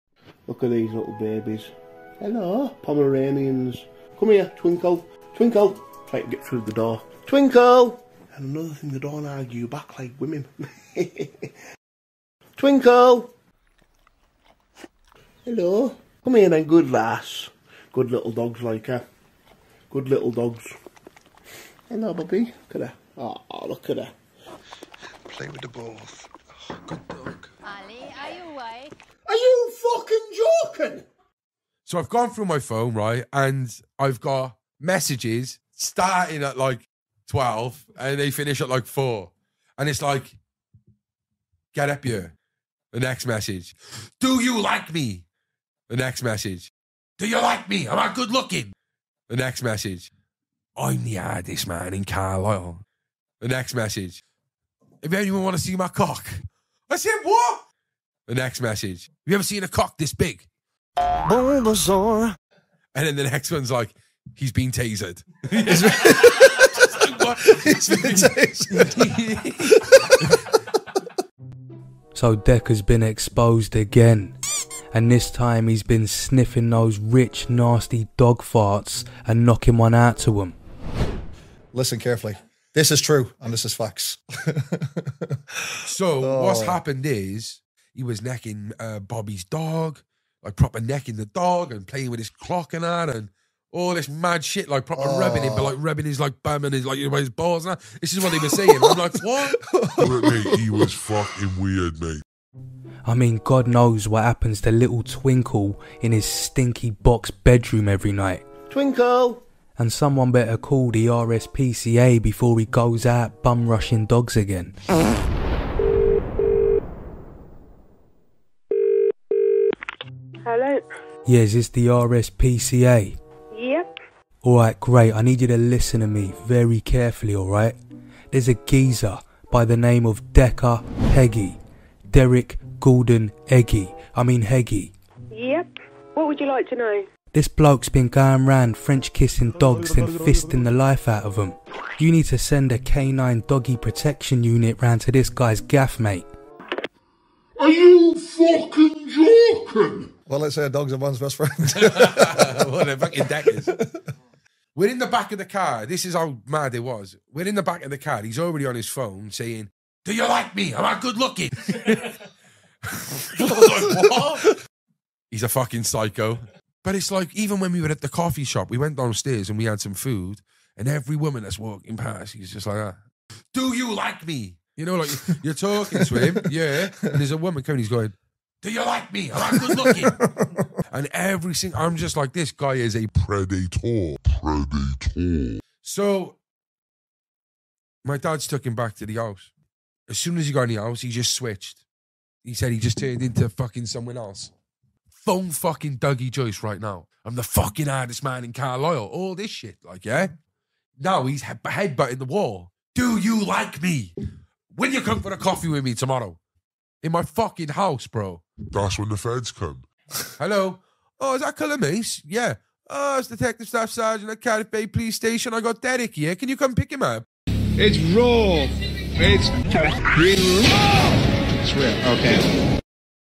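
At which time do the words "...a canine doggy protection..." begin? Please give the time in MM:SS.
02:22.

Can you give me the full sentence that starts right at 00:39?
And it's like, get up here.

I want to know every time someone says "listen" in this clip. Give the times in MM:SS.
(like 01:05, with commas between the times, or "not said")
01:21, 02:05.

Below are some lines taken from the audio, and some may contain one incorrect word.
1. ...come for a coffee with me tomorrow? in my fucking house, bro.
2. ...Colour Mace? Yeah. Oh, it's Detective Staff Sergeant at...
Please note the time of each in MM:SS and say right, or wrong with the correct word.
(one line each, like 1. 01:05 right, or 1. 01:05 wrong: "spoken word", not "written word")
1. 03:25 right
2. 03:31 right.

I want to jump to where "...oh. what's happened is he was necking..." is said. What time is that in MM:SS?
01:26.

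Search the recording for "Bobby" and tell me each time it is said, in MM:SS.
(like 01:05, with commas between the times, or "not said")
01:28.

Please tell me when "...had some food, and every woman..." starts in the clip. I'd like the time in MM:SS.
02:49.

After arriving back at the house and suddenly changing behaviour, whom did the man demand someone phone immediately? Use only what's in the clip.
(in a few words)
Dougie Joyce.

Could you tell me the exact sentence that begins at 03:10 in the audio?
As soon as he got in the house, he just switched.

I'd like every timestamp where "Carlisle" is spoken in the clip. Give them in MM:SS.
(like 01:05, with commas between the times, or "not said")
00:52, 03:18.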